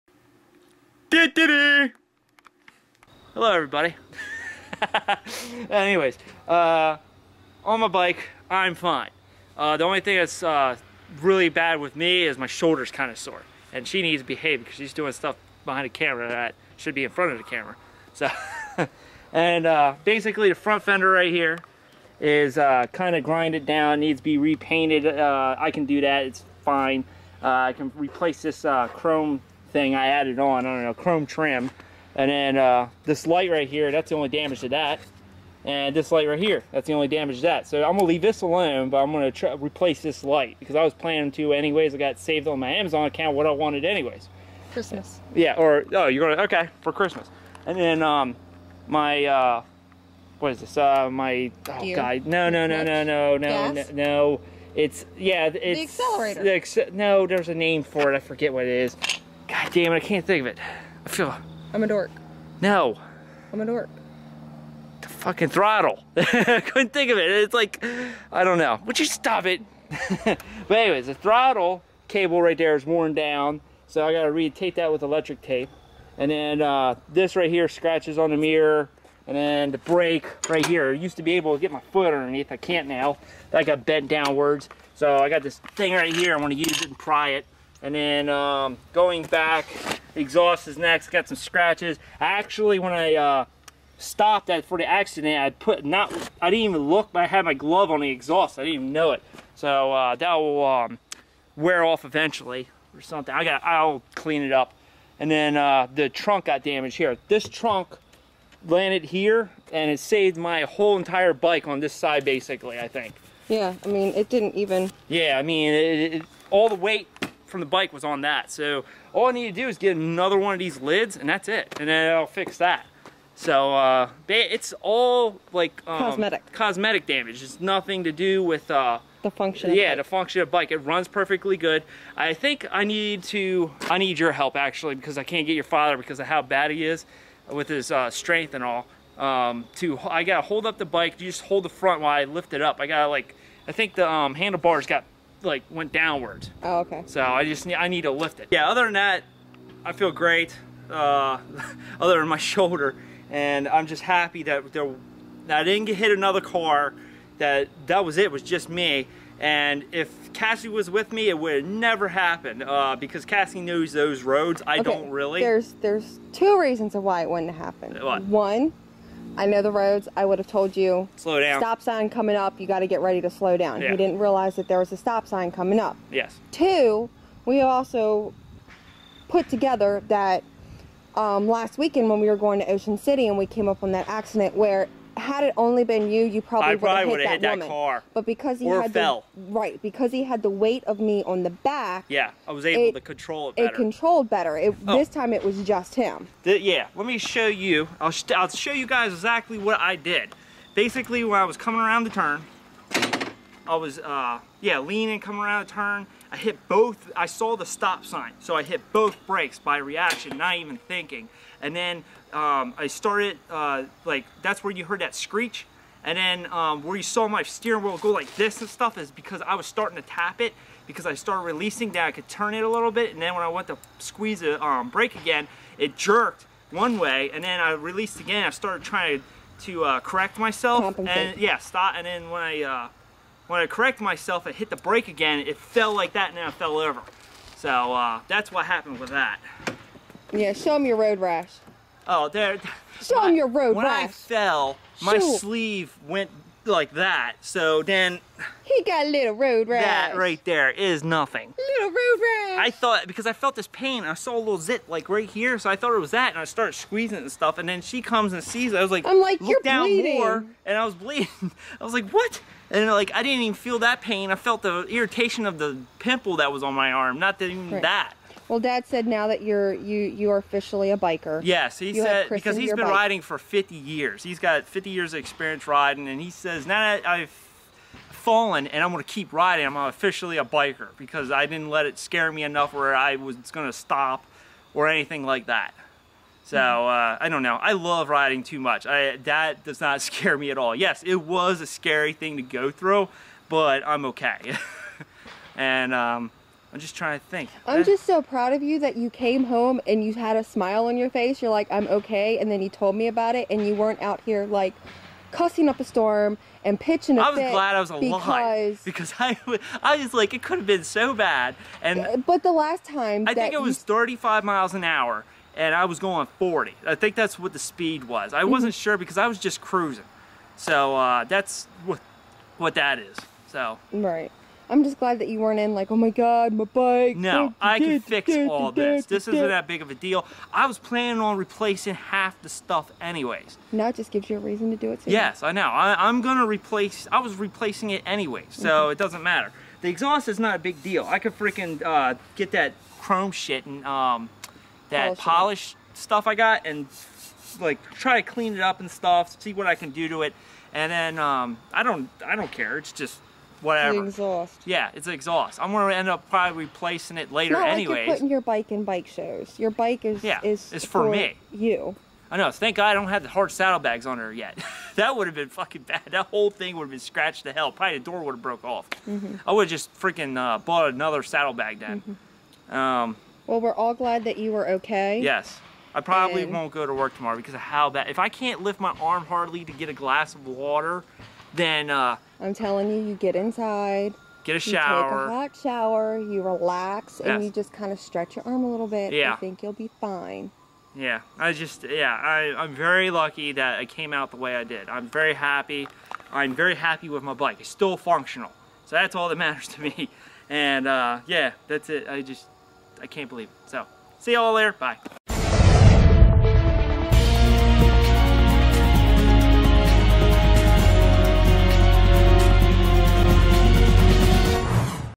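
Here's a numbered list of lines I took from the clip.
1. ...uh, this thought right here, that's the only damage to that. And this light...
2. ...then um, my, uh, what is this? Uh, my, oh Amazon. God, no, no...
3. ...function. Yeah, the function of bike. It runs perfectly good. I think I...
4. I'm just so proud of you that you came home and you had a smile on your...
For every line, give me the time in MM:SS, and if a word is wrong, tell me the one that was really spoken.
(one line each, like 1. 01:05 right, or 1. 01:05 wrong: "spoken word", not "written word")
1. 00:32 wrong: "light", not "thought"
2. 00:47 wrong: "Gear", not "Amazon"
3. 02:09 right
4. 04:57 right.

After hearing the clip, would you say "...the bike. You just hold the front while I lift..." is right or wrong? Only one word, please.
right.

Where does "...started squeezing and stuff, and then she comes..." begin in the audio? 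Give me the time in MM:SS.
04:16.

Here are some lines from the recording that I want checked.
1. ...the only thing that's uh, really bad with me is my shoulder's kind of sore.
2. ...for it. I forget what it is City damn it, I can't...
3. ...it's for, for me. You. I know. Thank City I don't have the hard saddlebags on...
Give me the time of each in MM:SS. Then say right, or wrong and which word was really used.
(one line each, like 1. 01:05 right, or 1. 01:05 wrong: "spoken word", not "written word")
1. 00:09 right
2. 00:57 wrong: "God", not "City"
3. 06:00 wrong: "God", not "City".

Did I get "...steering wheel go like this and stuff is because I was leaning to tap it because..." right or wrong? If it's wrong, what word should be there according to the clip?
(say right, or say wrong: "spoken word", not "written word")
wrong: "starting", not "leaning".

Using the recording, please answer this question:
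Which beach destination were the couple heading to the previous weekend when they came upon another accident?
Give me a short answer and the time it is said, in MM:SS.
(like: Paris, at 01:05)
Ocean City, at 03:02.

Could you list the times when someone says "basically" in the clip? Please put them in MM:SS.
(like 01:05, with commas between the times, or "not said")
00:20, 01:52, 03:20.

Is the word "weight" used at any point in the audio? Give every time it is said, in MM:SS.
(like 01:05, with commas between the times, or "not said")
01:56, 03:10.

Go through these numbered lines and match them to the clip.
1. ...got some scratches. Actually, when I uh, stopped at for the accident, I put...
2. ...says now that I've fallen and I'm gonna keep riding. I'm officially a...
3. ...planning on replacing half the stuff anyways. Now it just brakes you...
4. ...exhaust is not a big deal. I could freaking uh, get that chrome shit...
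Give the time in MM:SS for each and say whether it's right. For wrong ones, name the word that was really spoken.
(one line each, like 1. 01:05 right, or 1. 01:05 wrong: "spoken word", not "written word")
1. 01:31 right
2. 04:36 right
3. 05:30 wrong: "gives", not "brakes"
4. 05:39 right.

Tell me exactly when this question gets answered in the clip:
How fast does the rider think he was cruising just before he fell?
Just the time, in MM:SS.
05:16.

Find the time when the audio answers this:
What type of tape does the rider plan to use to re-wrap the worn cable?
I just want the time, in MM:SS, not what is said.
01:15.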